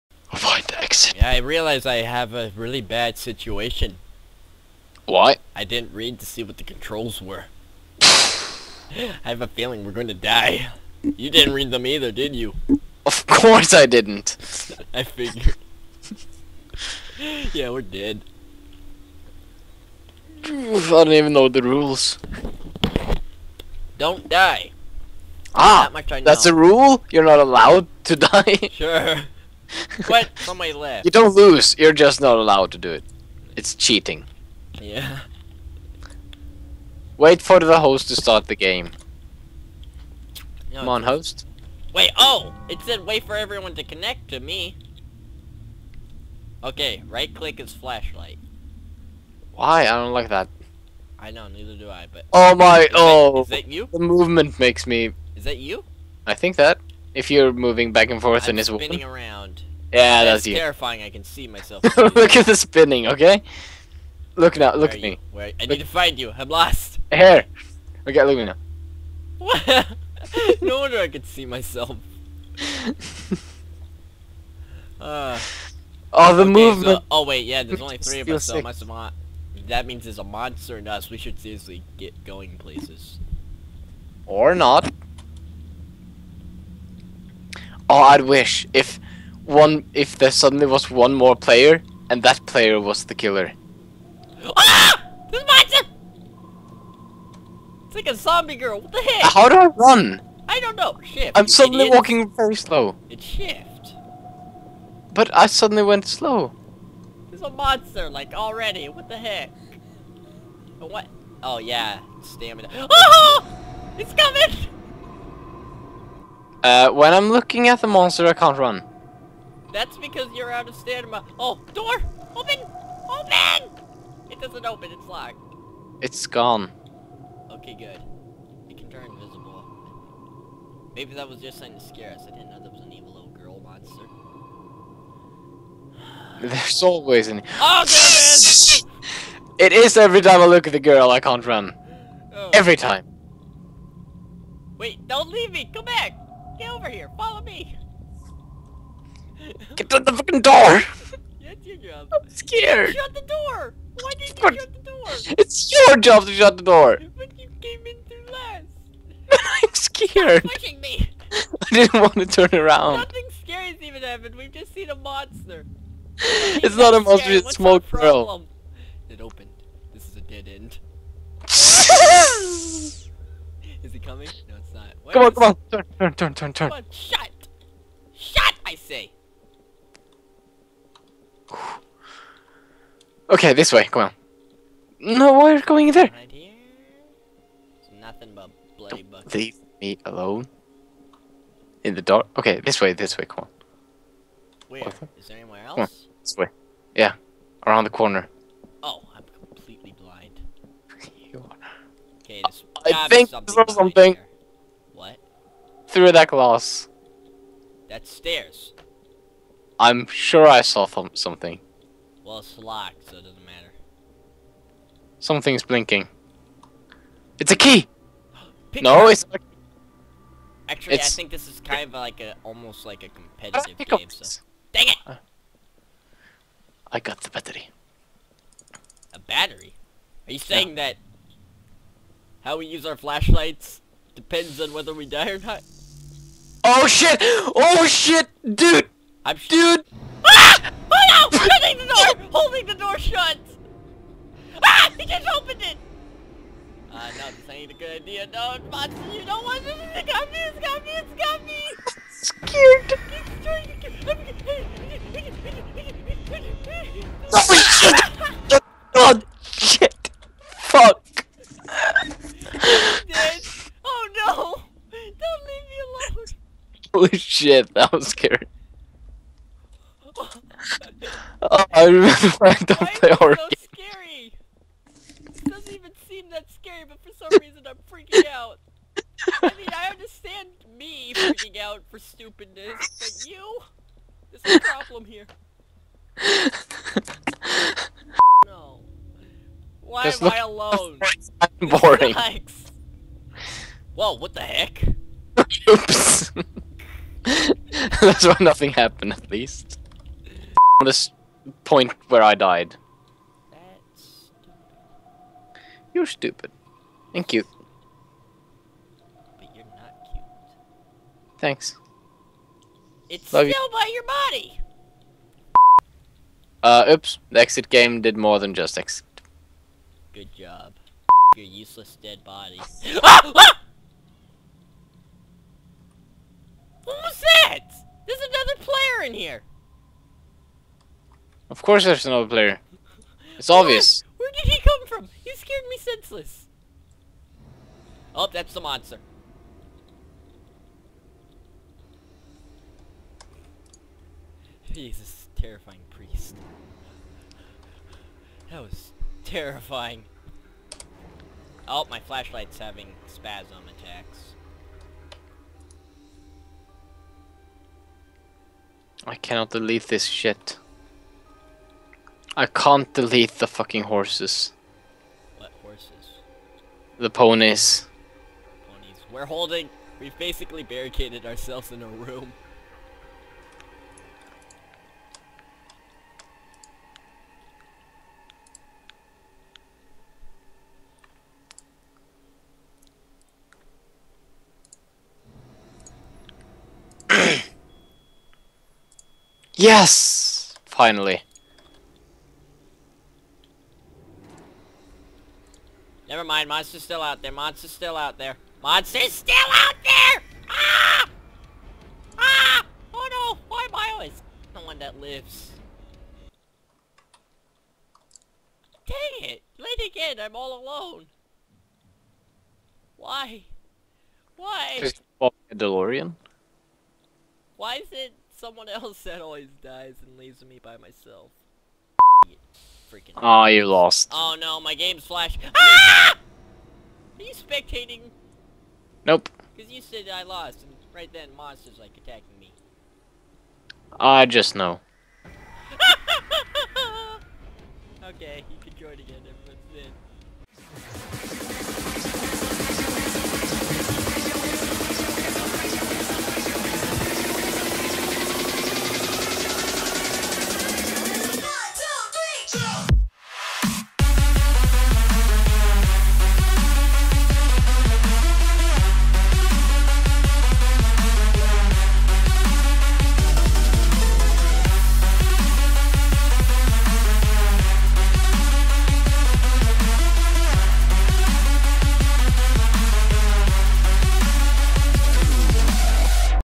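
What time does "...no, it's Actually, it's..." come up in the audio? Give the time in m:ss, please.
3:38.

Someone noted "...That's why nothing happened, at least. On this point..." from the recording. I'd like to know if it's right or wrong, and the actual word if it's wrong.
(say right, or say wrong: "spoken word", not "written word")
right.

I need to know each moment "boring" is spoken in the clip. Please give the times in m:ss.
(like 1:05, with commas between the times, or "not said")
4:51.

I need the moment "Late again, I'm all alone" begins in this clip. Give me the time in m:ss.
6:49.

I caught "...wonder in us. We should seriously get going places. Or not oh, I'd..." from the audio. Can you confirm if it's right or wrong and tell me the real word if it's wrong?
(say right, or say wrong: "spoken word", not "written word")
wrong: "monster", not "wonder".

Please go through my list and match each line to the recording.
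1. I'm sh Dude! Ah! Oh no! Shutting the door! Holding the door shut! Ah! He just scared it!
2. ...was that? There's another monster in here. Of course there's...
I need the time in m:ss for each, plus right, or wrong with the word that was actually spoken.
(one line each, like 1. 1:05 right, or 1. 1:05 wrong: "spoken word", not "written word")
1. 3:59 wrong: "opened", not "scared"
2. 5:27 wrong: "player", not "monster".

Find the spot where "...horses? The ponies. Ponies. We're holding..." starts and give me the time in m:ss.
6:05.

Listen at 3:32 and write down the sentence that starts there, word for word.
Well, it's locked, so it doesn't matter.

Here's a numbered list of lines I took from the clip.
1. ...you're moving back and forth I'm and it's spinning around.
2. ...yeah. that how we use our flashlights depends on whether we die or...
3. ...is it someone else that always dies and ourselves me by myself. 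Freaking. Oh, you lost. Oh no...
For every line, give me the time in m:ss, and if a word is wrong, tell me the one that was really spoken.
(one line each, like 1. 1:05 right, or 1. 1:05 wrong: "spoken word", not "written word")
1. 0:57 right
2. 3:50 right
3. 6:57 wrong: "leaves", not "ourselves".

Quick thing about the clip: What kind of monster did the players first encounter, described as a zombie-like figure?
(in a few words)
Zombie girl.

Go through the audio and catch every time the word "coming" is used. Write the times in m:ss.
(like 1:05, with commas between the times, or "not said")
1:54, 2:53.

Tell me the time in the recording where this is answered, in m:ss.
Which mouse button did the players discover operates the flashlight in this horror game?
0:47.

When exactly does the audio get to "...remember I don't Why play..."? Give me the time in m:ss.
4:31.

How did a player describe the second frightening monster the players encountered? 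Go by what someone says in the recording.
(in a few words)
Terrifying priest.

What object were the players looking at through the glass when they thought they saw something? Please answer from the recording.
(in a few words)
Stairs.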